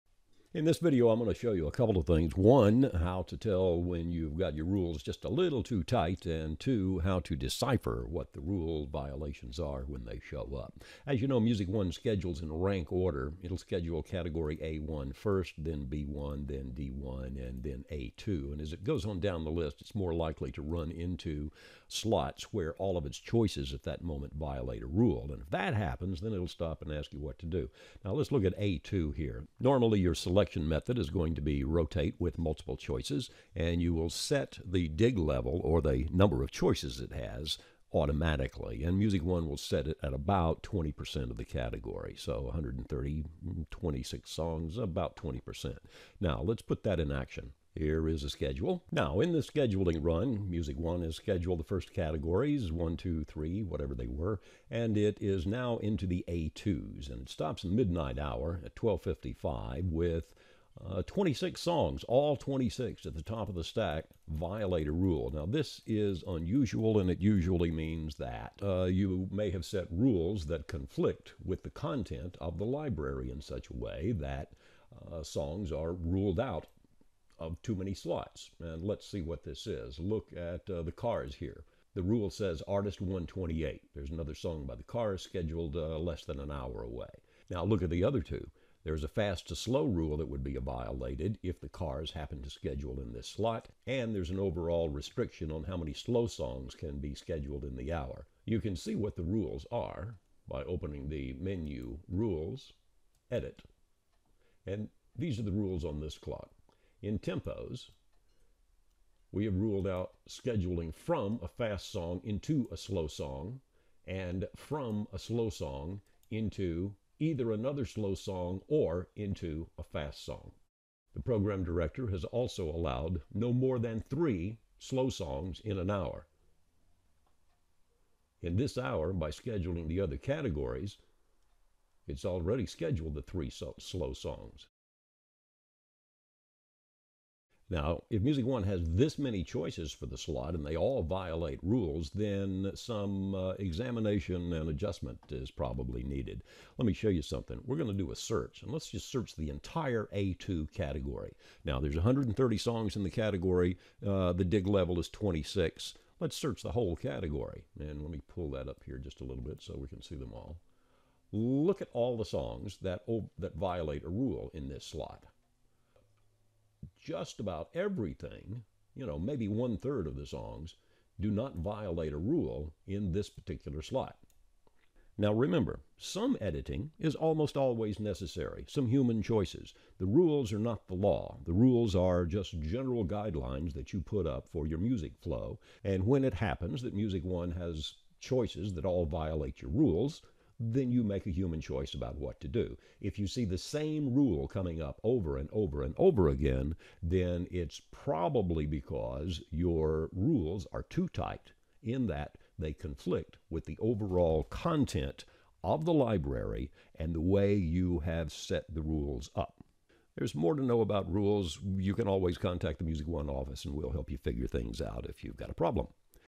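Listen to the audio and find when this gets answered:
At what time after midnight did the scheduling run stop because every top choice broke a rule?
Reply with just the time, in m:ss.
0:58.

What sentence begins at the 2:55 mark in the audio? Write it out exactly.
Now remember, some editing is almost always necessary, some human choices.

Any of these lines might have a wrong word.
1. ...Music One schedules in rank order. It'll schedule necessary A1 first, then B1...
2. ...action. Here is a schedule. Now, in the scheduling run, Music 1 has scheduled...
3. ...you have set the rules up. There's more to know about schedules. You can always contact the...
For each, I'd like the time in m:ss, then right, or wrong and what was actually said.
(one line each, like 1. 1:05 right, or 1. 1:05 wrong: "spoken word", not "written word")
1. 0:11 wrong: "category", not "necessary"
2. 0:47 right
3. 3:27 wrong: "rules", not "schedules".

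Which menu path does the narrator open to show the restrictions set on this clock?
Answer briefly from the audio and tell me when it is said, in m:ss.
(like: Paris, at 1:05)
Rules, Edit, at 1:42.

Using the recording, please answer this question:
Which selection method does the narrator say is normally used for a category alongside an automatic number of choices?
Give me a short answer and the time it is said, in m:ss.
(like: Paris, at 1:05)
Rotate with multiple choices, at 0:31.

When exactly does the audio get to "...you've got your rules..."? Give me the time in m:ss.
0:04.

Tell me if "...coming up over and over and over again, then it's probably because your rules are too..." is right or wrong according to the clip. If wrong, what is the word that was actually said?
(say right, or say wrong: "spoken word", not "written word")
right.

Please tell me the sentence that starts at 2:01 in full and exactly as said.
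The program director has also allowed no more than three slow songs in an hour.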